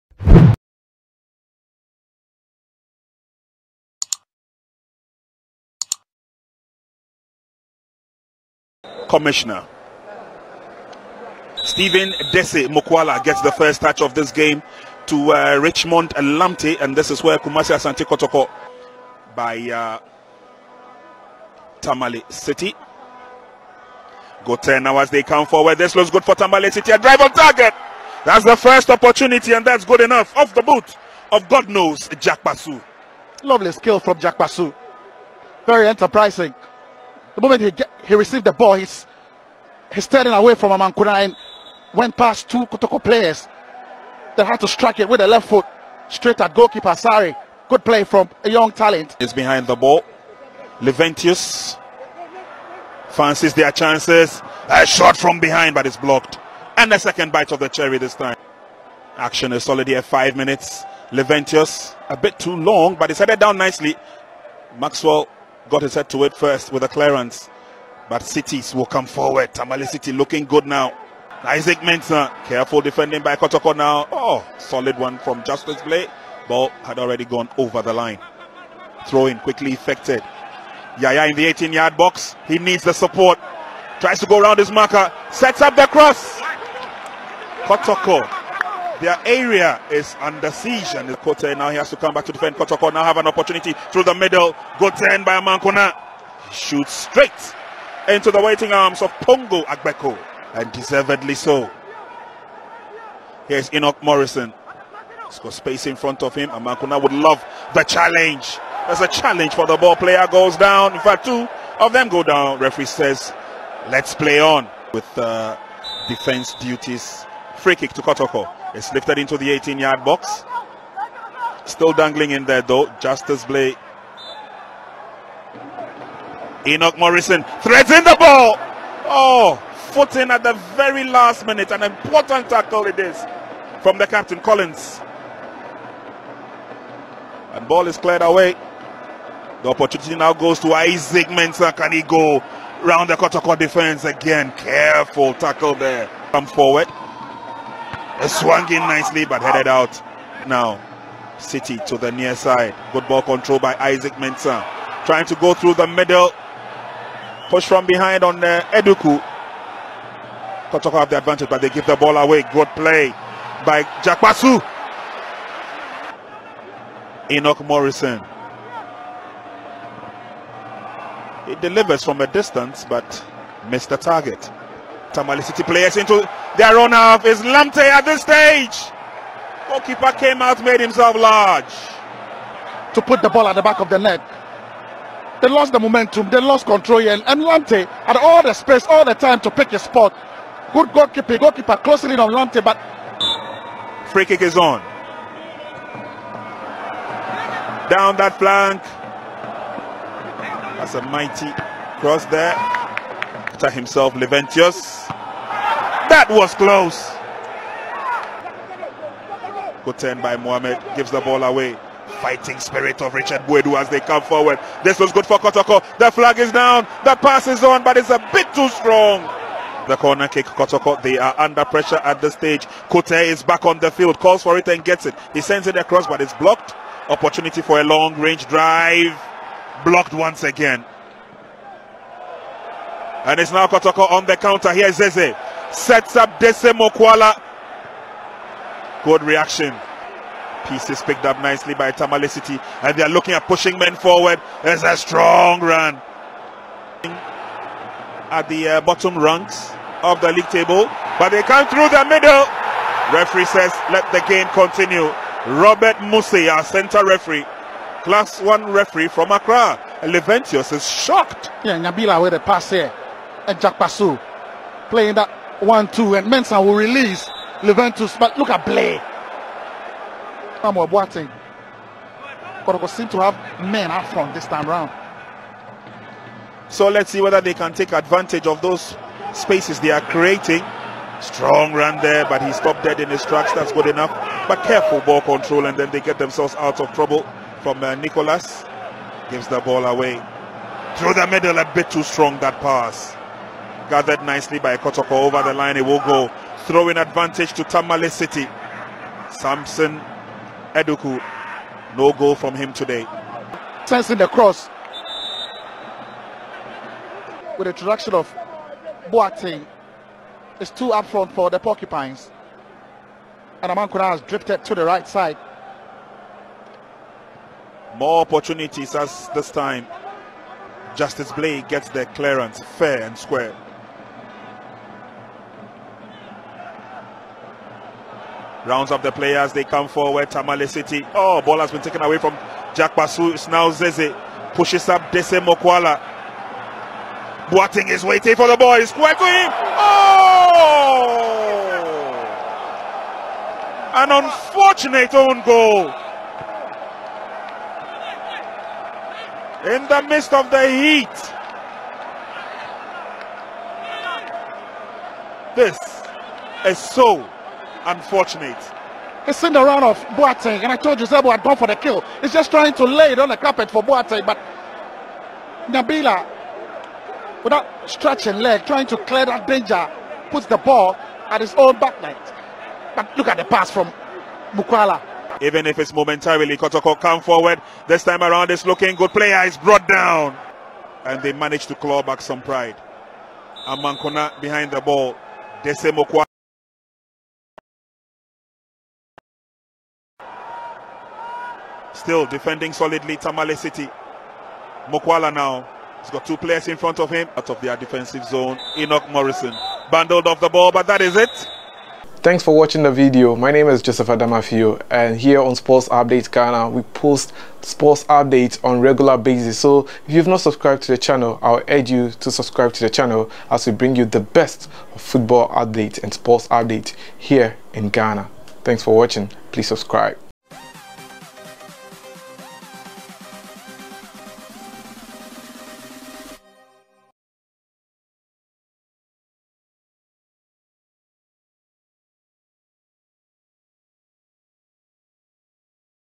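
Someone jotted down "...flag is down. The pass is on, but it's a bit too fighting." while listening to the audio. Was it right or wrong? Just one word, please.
wrong.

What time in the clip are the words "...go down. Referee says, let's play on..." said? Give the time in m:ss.
1:52.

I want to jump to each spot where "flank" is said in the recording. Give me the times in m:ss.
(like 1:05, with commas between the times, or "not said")
3:18.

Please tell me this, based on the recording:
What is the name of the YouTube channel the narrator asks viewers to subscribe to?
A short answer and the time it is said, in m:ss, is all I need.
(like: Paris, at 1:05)
Sports Update Ghana, at 6:45.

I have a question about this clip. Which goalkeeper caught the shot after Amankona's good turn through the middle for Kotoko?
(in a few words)
Pongo Agbeko.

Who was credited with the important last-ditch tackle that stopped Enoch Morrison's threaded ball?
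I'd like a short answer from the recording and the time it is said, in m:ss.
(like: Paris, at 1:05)
Collins, at 2:14.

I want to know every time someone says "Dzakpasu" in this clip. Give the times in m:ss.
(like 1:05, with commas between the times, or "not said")
2:44, 4:23, 5:32.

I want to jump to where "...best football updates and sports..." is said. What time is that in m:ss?
6:54.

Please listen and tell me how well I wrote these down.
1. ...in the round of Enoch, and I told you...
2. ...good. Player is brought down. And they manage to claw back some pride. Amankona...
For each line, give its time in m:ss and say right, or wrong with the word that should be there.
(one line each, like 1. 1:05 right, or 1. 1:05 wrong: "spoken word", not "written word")
1. 5:59 wrong: "Boateng", not "Enoch"
2. 6:18 right.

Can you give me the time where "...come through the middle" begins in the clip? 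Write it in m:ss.
4:11.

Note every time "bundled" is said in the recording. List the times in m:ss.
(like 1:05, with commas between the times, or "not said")
6:39.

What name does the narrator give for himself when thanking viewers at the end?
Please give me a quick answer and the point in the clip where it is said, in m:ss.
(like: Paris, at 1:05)
Joseph Adamafio, at 6:43.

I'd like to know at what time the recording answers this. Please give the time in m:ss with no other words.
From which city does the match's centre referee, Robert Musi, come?
4:19.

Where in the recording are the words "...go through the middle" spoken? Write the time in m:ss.
2:35.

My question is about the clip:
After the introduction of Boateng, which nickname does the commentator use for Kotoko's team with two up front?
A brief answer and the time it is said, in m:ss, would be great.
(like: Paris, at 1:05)
Porcupines, at 5:11.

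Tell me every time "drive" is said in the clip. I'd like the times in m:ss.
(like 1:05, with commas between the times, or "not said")
0:26, 3:48.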